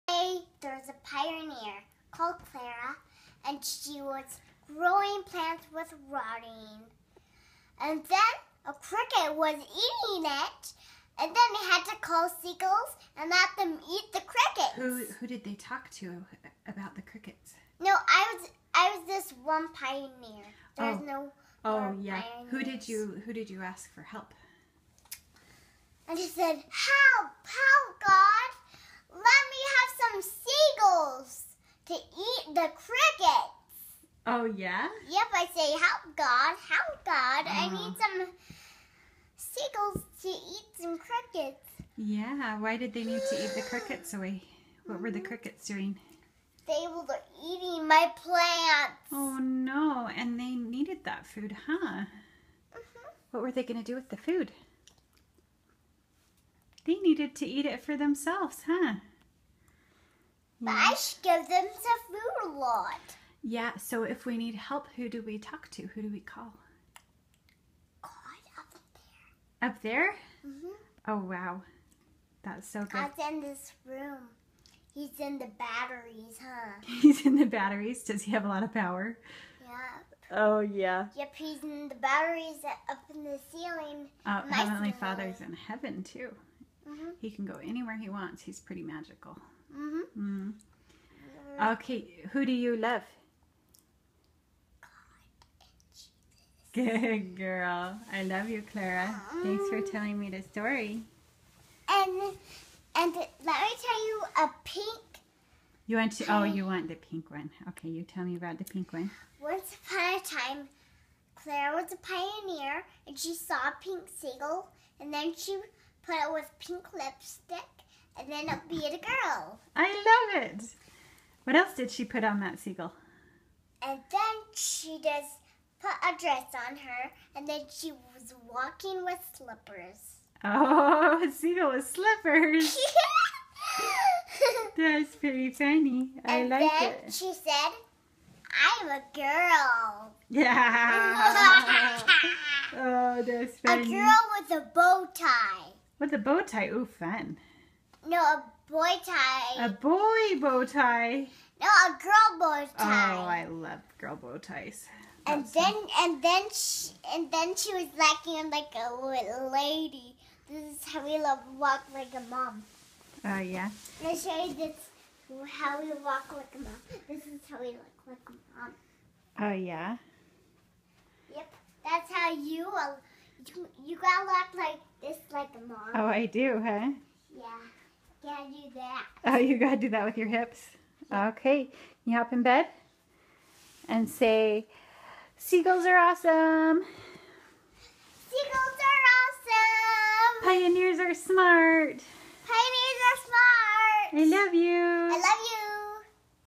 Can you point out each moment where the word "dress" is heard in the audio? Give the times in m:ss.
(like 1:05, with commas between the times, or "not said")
2:06.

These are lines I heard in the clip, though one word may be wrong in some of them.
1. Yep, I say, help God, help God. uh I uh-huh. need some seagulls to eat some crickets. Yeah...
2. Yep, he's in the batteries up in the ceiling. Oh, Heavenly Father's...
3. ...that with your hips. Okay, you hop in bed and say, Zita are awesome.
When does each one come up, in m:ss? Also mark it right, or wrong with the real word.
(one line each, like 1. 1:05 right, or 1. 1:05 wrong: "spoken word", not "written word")
1. 0:35 right
2. 1:21 right
3. 2:59 wrong: "Seagulls", not "Zita".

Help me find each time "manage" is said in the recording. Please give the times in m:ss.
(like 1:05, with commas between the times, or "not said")
not said.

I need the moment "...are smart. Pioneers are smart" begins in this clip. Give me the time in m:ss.
3:10.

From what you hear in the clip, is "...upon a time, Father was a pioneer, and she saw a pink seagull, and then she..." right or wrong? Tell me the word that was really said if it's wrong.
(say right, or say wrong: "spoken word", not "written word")
wrong: "Clara", not "Father".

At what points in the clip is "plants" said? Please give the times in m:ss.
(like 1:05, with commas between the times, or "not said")
0:05, 0:48.